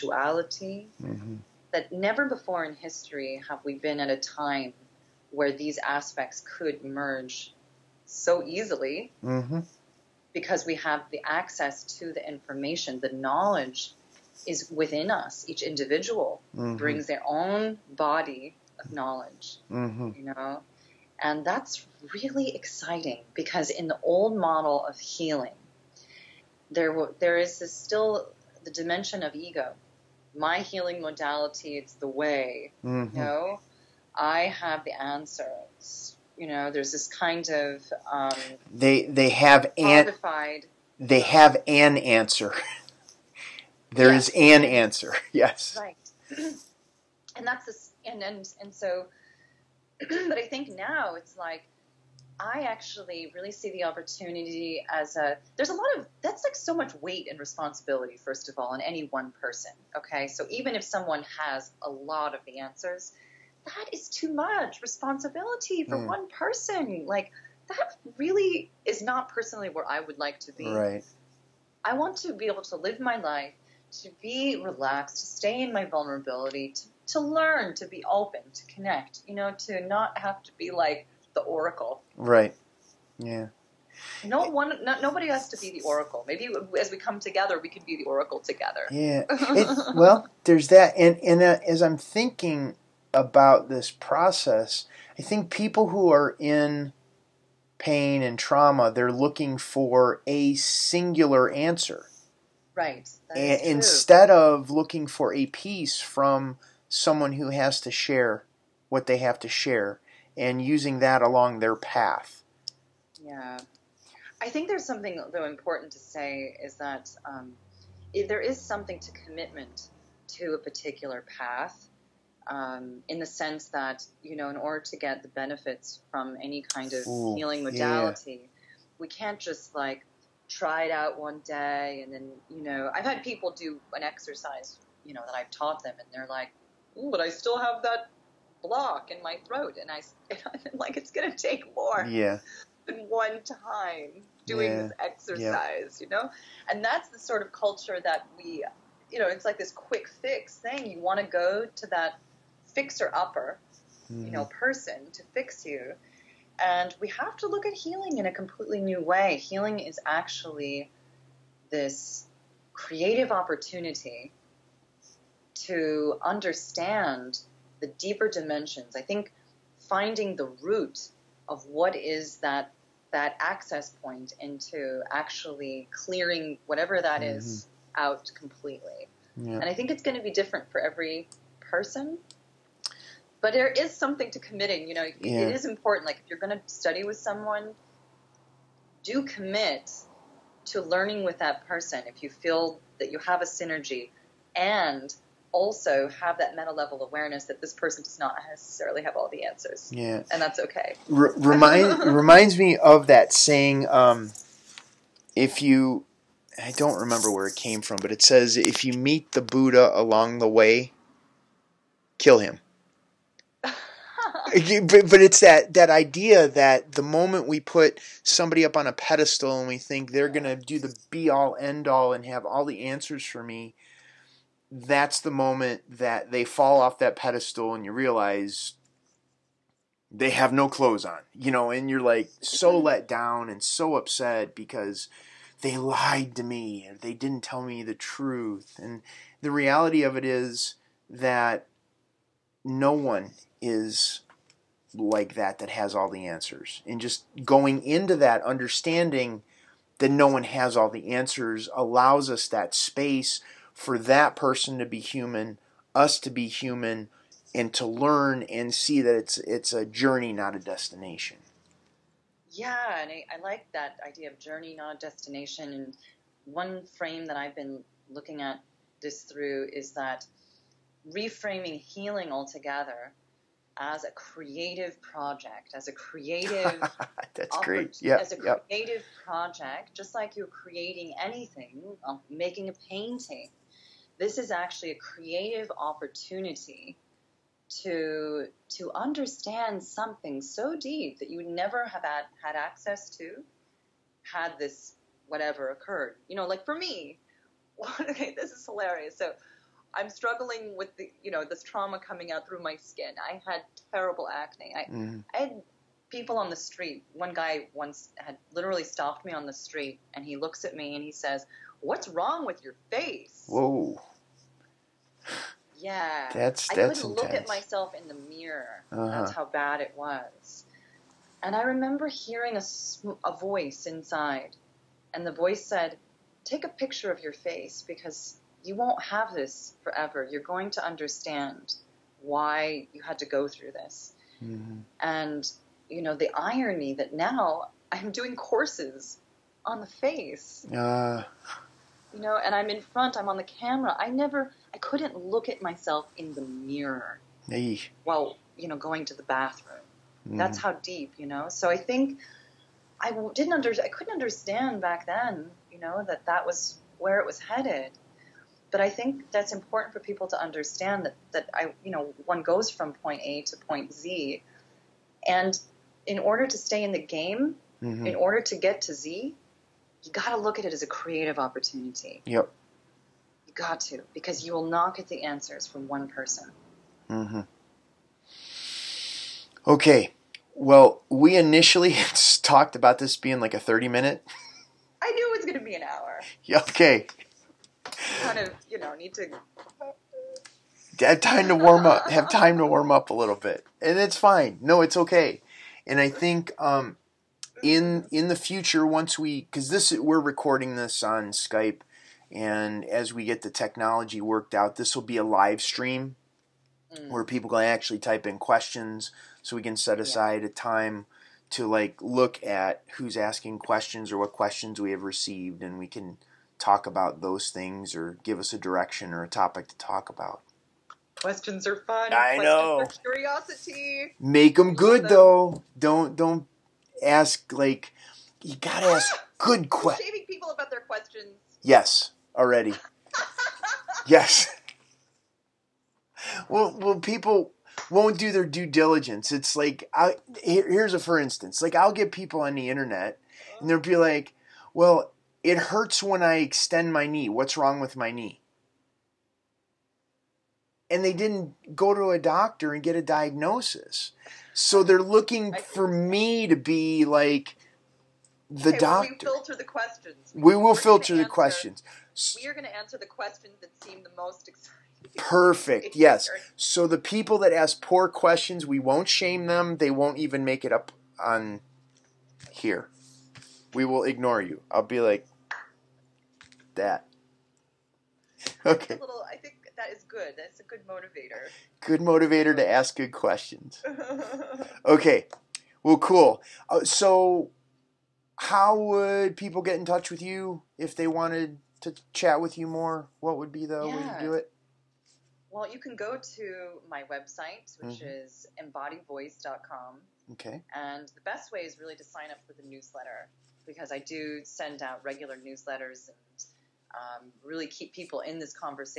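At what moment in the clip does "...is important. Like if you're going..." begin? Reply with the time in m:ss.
3:05.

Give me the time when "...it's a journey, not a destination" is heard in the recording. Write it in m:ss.
4:19.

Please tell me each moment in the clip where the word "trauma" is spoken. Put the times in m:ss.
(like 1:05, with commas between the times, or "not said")
1:38, 5:01.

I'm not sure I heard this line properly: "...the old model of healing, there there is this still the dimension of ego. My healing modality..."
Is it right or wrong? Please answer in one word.
right.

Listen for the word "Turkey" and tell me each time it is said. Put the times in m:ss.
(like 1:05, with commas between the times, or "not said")
not said.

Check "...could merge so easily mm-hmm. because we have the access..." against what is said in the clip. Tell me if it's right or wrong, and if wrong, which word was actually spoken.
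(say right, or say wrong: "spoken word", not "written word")
right.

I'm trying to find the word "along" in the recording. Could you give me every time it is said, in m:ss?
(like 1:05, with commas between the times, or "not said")
1:51, 3:29.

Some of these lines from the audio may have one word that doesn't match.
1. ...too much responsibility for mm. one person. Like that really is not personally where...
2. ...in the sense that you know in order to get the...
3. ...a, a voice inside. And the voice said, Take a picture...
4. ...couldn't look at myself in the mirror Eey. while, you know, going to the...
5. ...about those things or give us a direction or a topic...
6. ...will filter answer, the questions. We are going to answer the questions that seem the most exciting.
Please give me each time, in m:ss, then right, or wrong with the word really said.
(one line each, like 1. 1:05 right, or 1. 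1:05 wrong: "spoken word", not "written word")
1. 1:04 right
2. 2:03 right
3. 5:22 right
4. 5:44 right
5. 6:56 right
6. 7:40 right.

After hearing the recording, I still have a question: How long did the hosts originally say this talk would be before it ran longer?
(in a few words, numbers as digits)
30 minutes.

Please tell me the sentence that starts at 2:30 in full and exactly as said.
You want to go to that fixer upper, mm.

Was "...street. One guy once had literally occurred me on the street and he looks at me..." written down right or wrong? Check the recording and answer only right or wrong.
wrong.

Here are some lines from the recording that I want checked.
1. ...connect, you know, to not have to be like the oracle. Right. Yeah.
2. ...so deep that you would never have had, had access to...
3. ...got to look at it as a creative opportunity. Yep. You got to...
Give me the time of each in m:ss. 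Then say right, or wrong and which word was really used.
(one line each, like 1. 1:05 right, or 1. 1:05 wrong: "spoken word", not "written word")
1. 1:18 right
2. 4:50 right
3. 6:10 right.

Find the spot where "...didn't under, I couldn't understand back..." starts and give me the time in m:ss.
5:53.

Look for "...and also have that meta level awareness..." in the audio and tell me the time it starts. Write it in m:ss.
3:14.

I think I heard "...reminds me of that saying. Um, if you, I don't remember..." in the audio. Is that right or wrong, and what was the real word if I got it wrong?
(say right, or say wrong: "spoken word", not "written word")
right.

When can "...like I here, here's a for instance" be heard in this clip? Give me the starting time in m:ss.
7:19.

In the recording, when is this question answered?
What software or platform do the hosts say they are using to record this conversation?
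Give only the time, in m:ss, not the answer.
6:41.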